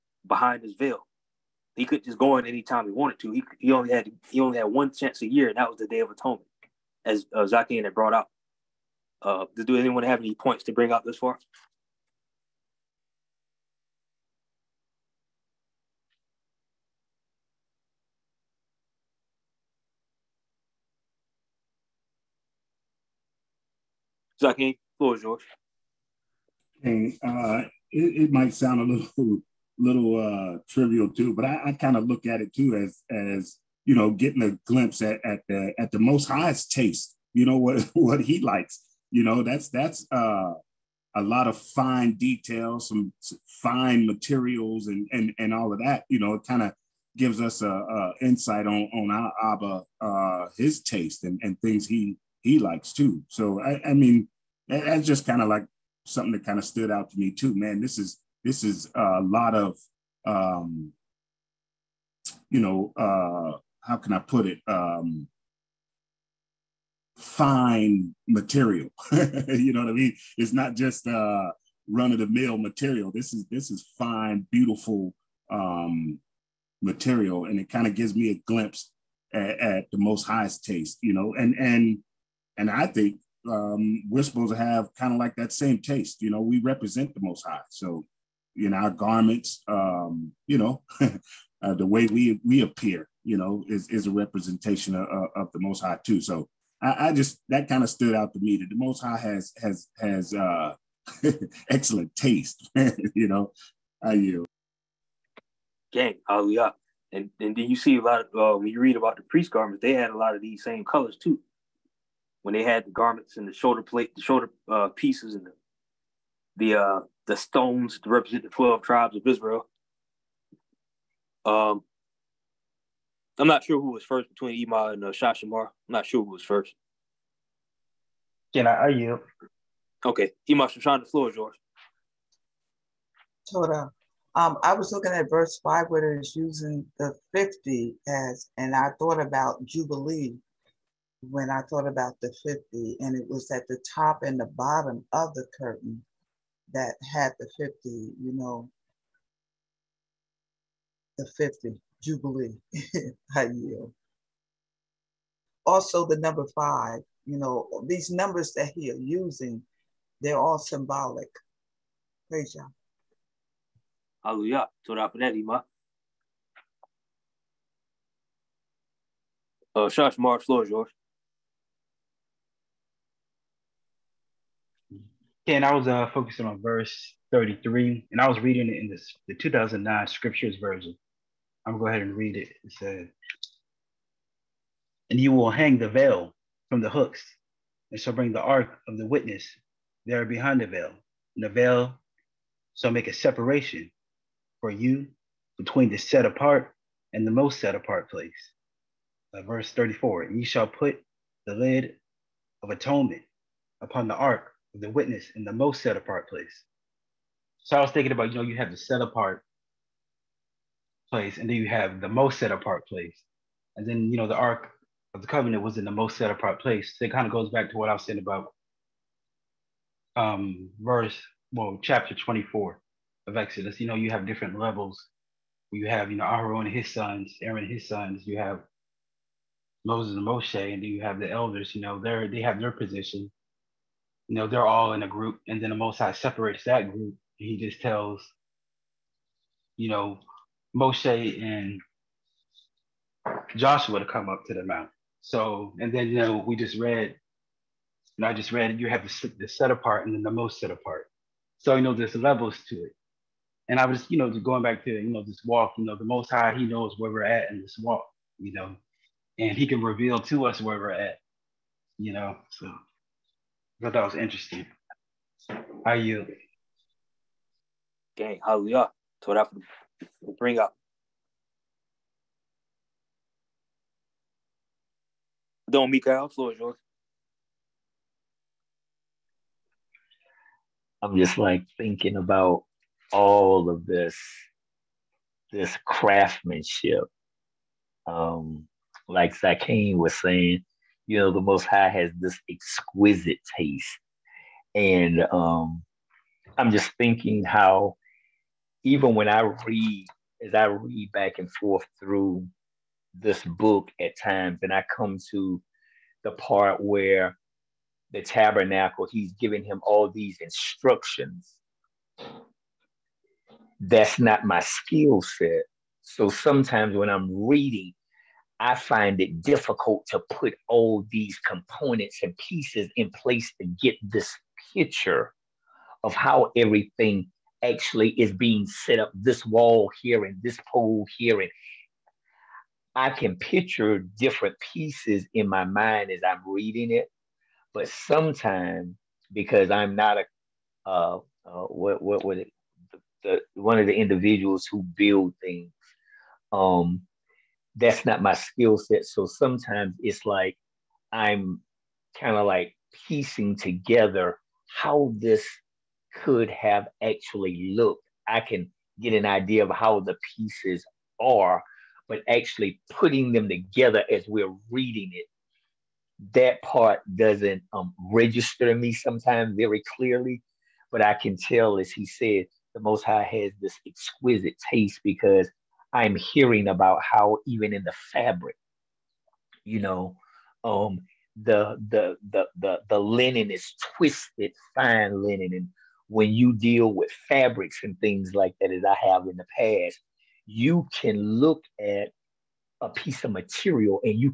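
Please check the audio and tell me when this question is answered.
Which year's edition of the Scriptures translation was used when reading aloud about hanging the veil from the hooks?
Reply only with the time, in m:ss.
2:59.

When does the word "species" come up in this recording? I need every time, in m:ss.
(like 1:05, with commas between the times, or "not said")
not said.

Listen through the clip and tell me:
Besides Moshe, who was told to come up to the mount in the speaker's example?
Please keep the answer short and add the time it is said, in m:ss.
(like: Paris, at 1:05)
Joshua, at 4:03.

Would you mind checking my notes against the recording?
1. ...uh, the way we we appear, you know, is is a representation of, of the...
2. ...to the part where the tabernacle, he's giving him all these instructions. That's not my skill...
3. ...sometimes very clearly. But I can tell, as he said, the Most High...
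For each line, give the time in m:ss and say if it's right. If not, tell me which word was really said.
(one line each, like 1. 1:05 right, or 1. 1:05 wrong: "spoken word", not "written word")
1. 1:31 right
2. 5:05 right
3. 6:08 right.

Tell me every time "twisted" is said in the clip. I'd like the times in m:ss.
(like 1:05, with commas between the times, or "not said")
6:23.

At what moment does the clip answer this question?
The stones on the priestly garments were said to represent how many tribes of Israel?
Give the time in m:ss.
1:58.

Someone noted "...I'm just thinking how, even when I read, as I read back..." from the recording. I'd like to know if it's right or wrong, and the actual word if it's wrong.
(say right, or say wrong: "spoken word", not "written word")
right.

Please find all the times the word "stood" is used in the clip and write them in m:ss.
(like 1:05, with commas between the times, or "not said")
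0:56, 1:37.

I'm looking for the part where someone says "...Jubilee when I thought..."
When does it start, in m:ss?
2:19.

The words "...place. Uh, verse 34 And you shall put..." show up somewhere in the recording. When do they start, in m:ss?
3:18.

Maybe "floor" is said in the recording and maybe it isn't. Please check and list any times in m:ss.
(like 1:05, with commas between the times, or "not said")
0:24, 2:11, 2:50, 4:36.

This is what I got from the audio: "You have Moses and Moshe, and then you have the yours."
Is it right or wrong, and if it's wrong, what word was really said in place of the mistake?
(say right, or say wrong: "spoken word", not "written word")
wrong: "elders", not "yours".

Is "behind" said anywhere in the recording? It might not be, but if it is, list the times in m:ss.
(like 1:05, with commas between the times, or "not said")
0:00, 3:10.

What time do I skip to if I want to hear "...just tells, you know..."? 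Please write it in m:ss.
3:57.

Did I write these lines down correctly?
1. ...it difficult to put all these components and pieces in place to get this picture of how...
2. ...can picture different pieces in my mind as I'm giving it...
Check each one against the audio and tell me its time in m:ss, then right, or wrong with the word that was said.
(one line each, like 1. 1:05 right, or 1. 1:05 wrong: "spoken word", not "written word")
1. 5:19 right
2. 5:33 wrong: "reading", not "giving".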